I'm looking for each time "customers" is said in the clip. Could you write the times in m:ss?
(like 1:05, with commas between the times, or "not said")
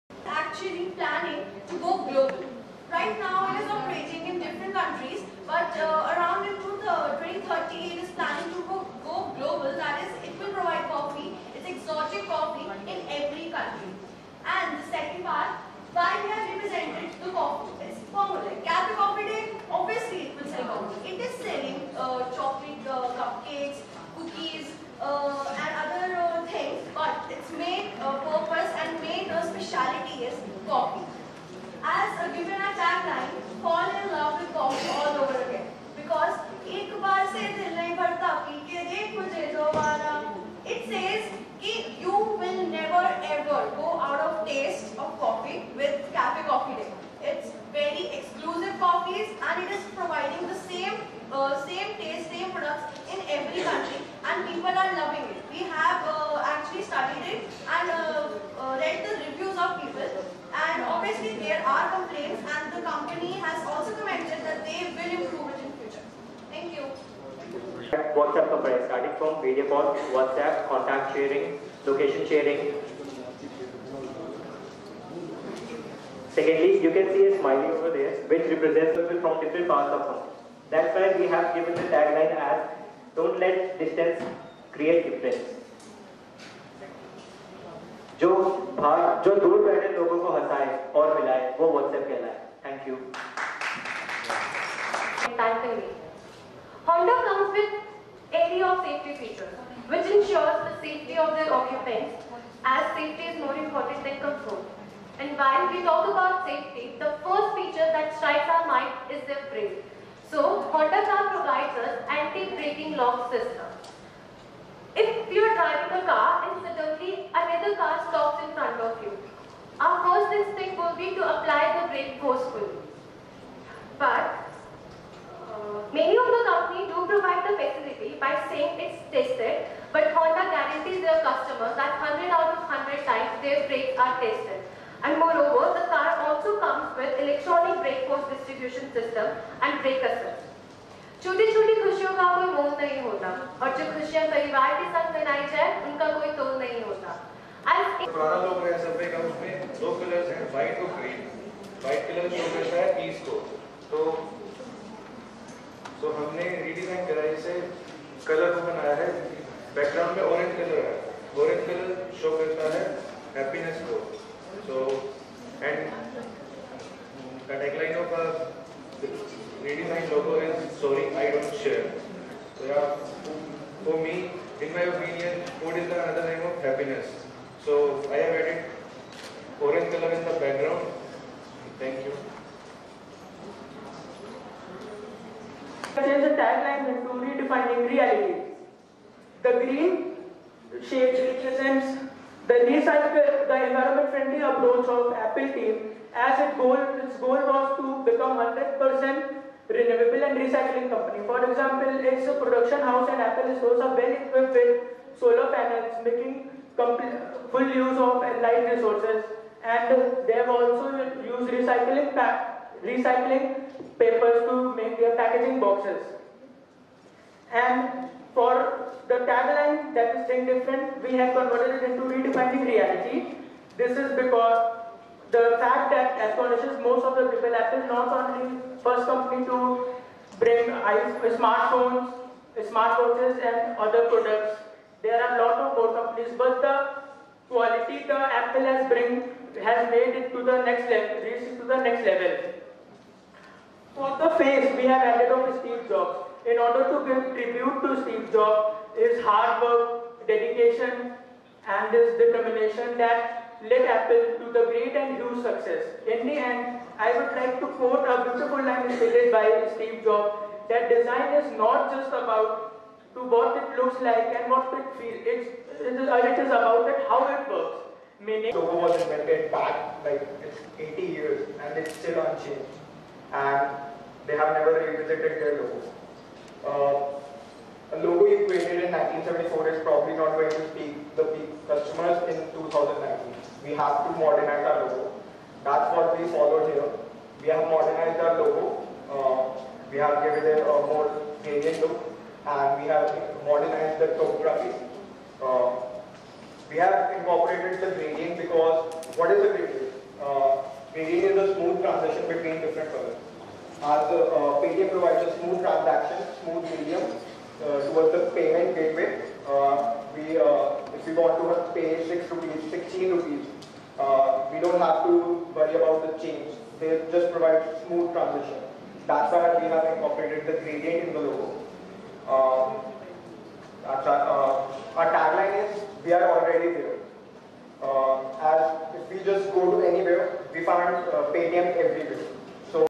2:11, 4:41.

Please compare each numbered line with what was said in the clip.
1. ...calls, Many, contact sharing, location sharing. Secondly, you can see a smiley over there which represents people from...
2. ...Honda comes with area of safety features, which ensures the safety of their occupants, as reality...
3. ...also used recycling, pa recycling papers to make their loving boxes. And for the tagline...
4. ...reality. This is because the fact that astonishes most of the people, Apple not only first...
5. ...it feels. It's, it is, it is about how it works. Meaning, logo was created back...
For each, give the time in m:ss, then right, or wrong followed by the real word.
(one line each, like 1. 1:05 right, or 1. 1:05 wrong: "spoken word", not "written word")
1. 1:09 wrong: "WhatsApp", not "Many"
2. 1:36 wrong: "safety", not "reality"
3. 3:30 wrong: "packaging", not "loving"
4. 3:42 right
5. 4:24 wrong: "invented", not "created".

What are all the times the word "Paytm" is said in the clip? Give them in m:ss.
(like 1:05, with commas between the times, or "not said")
5:04, 5:31.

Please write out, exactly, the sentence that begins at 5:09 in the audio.
Uh, we, uh, if we want to pay 6 rupees, 16 rupees, we don't have to worry about the change.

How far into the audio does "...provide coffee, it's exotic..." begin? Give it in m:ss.
0:10.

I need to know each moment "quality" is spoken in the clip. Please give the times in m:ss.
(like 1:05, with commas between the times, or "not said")
3:57.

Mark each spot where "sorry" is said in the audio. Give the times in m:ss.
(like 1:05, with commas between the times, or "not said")
2:50.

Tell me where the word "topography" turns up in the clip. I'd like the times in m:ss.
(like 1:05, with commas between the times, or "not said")
4:54.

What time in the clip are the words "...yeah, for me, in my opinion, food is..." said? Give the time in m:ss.
2:52.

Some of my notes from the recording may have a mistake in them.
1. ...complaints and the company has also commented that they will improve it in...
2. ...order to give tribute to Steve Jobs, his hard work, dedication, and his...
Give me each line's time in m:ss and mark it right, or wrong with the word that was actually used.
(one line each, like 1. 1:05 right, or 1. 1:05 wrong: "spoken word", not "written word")
1. 1:01 right
2. 4:06 right.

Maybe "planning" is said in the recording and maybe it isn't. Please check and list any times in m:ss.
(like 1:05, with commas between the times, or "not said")
0:00, 0:08.